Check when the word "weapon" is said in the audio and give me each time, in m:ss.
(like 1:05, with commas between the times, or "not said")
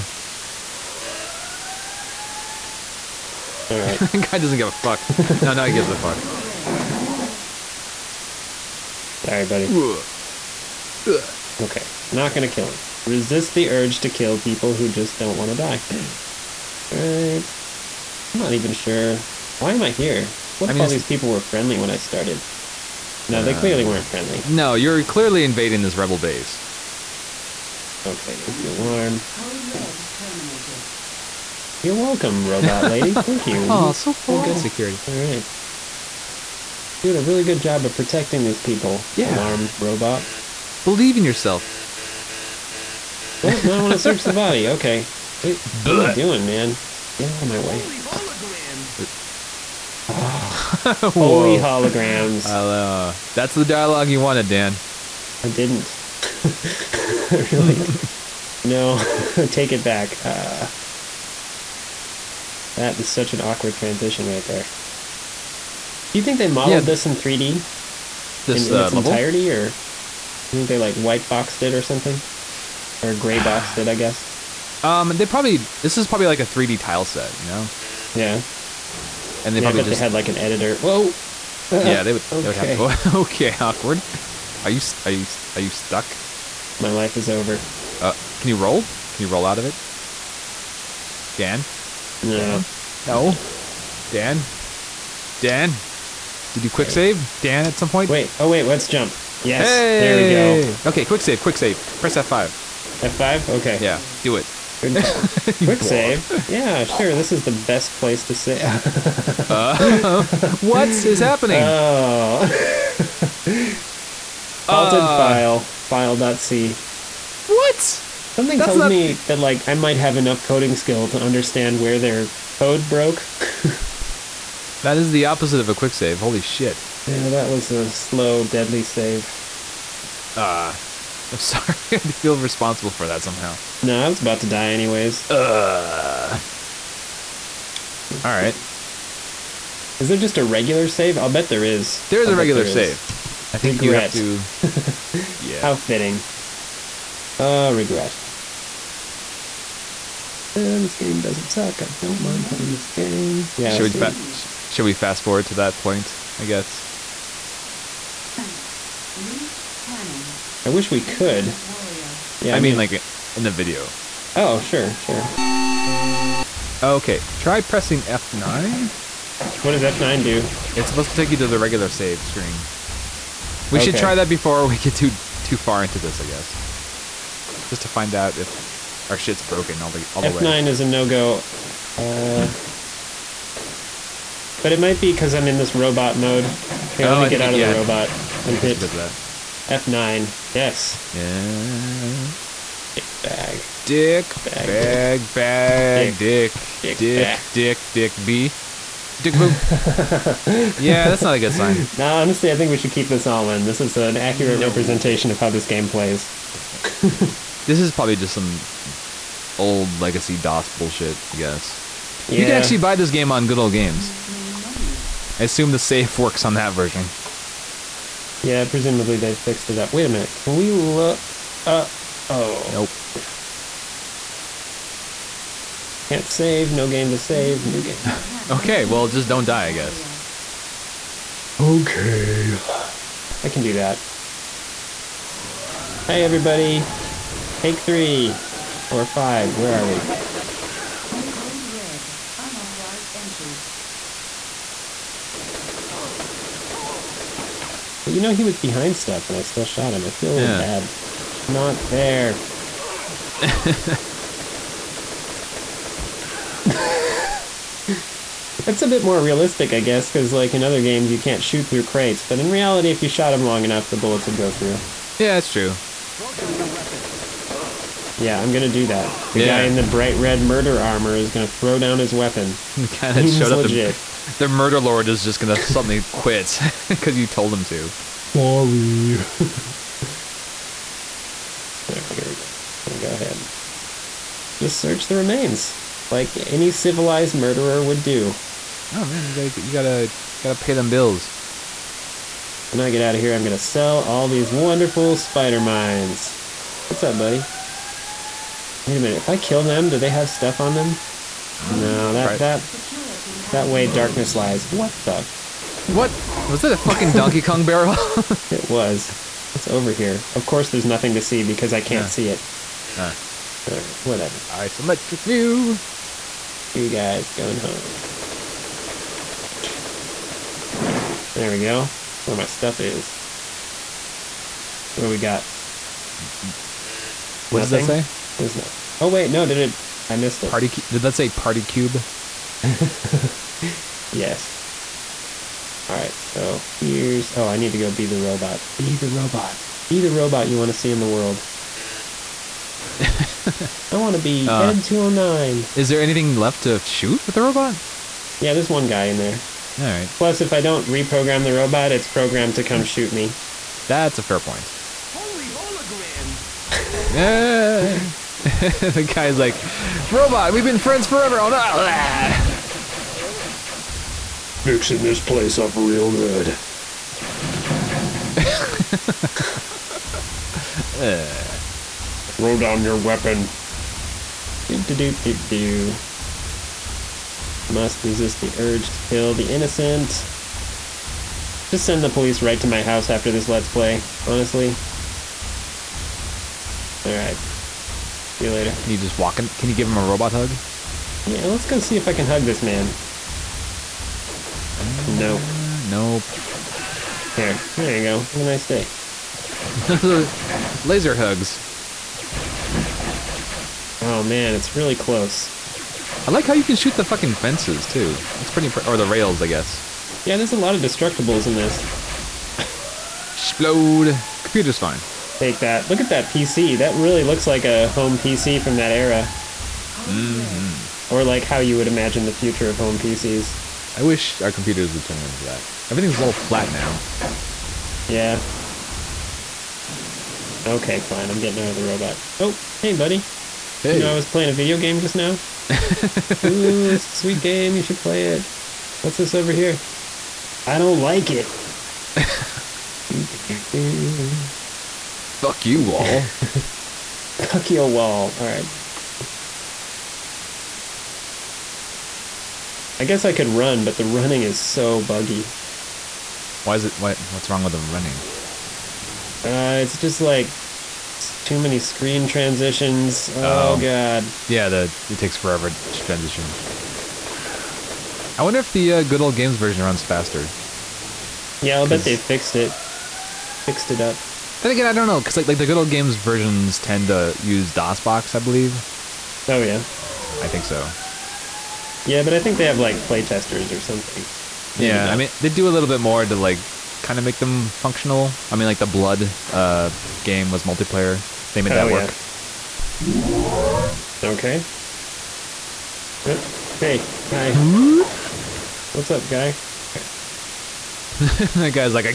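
4:26, 4:32, 6:12.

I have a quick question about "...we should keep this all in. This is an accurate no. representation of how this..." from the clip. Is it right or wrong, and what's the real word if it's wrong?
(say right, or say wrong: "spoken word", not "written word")
right.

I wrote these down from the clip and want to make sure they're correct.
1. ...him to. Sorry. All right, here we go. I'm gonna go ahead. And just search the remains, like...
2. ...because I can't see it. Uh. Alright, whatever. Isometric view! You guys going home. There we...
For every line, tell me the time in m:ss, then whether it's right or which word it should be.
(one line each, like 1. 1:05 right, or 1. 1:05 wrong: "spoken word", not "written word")
1. 4:37 right
2. 5:11 right.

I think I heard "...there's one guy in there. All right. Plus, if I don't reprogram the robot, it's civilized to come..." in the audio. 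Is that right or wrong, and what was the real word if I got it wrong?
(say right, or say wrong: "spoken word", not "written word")
wrong: "programmed", not "civilized".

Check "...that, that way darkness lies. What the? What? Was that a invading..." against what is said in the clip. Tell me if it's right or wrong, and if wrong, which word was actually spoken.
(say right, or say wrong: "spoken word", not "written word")
wrong: "fucking", not "invading".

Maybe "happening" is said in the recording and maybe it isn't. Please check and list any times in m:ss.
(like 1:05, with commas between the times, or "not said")
1:51.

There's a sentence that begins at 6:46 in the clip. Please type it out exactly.
I like how you can shoot the fucking fences too.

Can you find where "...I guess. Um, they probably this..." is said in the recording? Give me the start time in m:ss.
1:13.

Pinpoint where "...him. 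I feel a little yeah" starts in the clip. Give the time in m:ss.
4:09.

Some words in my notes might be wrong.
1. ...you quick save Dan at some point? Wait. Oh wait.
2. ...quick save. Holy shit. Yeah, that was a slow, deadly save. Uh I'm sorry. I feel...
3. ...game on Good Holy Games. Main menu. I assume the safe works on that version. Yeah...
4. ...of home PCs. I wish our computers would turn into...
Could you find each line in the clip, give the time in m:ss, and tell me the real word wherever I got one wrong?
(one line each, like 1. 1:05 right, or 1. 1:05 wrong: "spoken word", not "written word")
1. 1:36 right
2. 2:05 right
3. 3:33 wrong: "Old", not "Holy"
4. 7:02 right.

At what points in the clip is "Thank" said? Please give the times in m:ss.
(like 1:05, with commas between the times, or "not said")
0:33.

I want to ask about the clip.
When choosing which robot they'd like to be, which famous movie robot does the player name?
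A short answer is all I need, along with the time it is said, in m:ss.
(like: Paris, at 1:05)
ED-209, at 5:44.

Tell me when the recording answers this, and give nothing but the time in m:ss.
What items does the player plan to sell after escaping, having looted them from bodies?
4:55.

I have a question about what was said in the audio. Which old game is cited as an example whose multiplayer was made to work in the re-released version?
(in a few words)
Blood.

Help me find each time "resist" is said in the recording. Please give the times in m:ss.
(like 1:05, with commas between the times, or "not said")
0:13, 6:18.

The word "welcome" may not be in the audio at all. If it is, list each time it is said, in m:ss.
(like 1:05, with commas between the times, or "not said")
0:31.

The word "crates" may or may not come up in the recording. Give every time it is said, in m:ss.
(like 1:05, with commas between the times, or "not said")
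4:21.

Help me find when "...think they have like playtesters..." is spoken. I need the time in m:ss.
8:02.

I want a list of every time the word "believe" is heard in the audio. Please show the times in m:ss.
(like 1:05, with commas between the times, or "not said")
0:40, 7:58.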